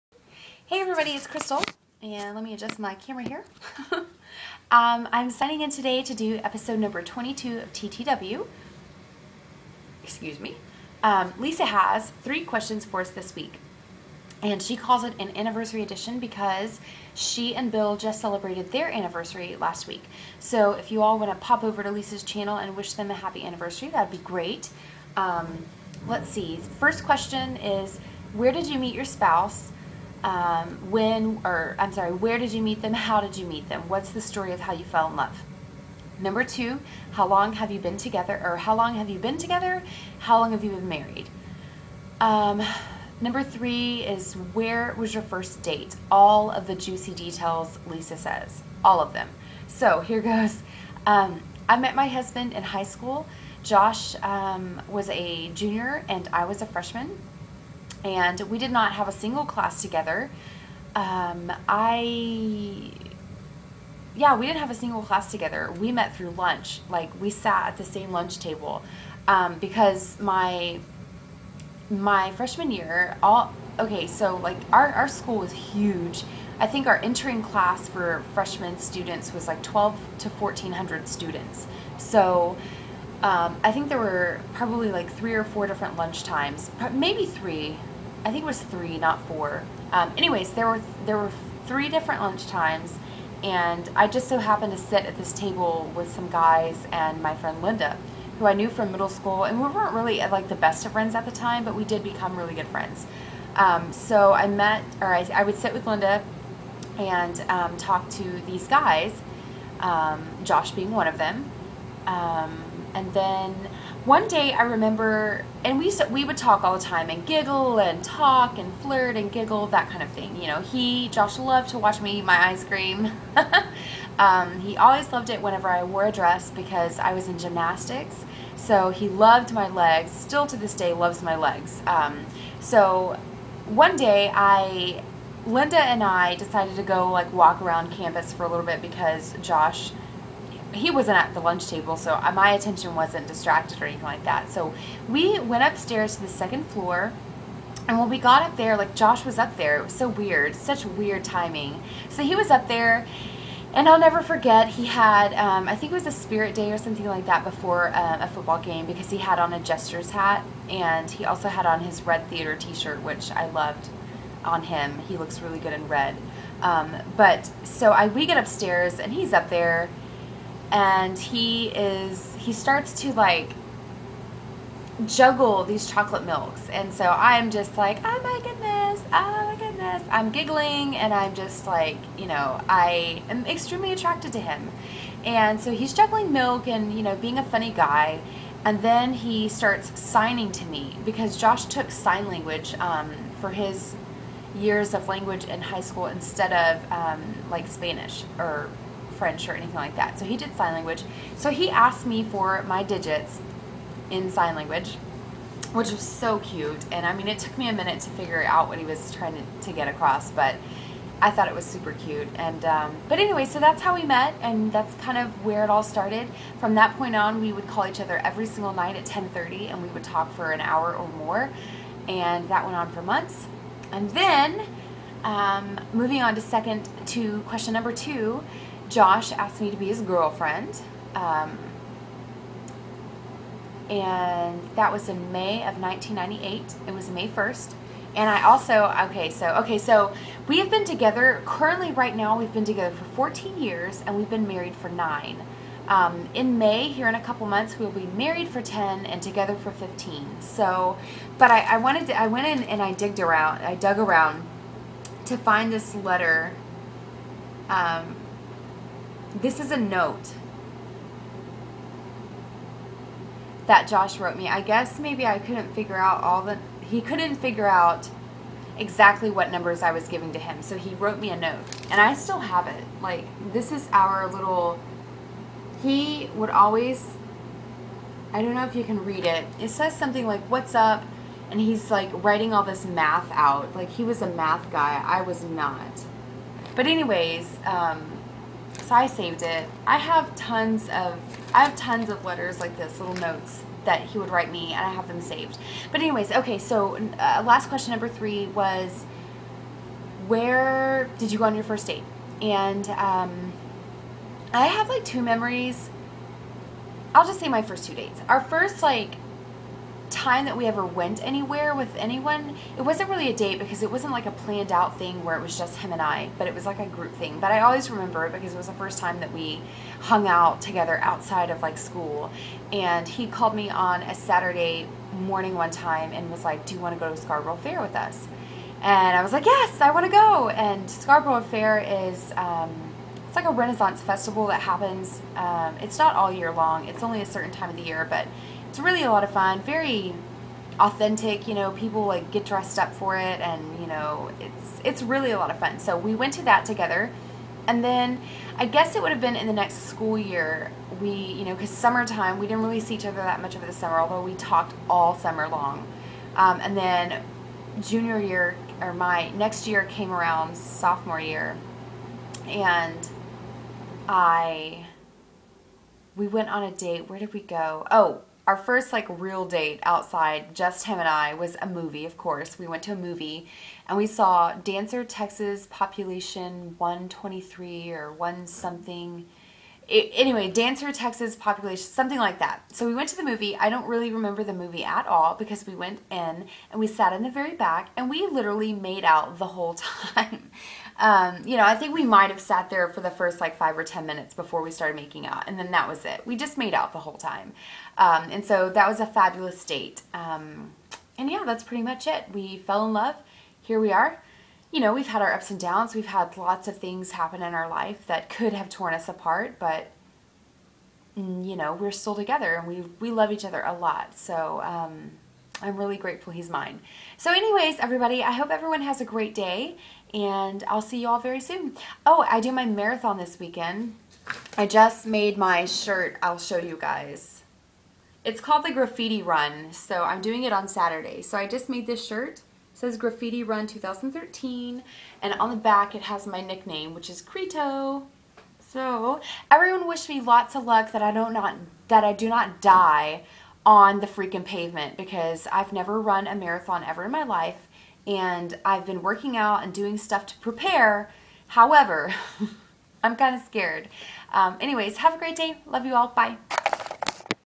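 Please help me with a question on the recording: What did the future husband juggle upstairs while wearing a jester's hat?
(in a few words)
Chocolate milks.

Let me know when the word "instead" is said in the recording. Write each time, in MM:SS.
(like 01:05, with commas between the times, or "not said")
03:16.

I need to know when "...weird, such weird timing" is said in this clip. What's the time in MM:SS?
02:30.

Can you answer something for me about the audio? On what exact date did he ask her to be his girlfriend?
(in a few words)
May 1st, 1998.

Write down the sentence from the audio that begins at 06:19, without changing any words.
It, anyway, Dancer Texas Population, something like that.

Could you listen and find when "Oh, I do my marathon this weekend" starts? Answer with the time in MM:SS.
07:02.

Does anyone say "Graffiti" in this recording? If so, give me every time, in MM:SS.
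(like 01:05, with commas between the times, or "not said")
07:08, 07:12.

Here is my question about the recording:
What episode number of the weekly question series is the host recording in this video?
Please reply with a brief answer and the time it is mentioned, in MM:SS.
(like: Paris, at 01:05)
22, at 00:07.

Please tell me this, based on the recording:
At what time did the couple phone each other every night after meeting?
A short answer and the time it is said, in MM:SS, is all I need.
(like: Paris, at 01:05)
10:30, at 03:39.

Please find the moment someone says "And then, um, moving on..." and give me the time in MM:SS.
03:43.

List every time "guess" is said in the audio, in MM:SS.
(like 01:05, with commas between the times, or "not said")
04:24, 05:48.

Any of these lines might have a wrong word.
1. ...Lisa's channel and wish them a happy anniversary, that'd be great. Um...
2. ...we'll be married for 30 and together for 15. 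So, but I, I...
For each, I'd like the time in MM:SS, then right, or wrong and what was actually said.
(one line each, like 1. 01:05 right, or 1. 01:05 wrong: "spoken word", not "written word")
1. 00:21 right
2. 04:07 wrong: "10", not "30".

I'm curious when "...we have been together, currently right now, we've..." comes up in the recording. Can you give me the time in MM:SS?
04:00.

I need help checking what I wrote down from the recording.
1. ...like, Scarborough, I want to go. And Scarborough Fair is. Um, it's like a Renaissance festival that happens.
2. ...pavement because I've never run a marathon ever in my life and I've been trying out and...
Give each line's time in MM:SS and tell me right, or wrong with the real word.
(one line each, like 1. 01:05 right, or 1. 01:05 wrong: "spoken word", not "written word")
1. 05:29 wrong: "Yes", not "Scarborough"
2. 07:24 wrong: "working", not "trying".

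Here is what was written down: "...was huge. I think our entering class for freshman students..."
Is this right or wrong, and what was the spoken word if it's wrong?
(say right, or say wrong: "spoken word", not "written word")
right.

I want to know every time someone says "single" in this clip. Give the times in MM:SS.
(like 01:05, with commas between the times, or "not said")
00:59, 01:04, 03:38.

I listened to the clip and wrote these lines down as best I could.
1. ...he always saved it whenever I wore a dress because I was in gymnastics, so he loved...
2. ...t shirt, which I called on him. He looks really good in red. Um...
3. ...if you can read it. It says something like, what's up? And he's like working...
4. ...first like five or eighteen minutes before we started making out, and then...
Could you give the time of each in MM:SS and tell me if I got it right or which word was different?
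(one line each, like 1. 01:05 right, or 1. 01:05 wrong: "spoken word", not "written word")
1. 02:04 wrong: "loved", not "saved"
2. 02:42 wrong: "loved", not "called"
3. 04:38 wrong: "writing", not "working"
4. 06:33 wrong: "ten", not "eighteen".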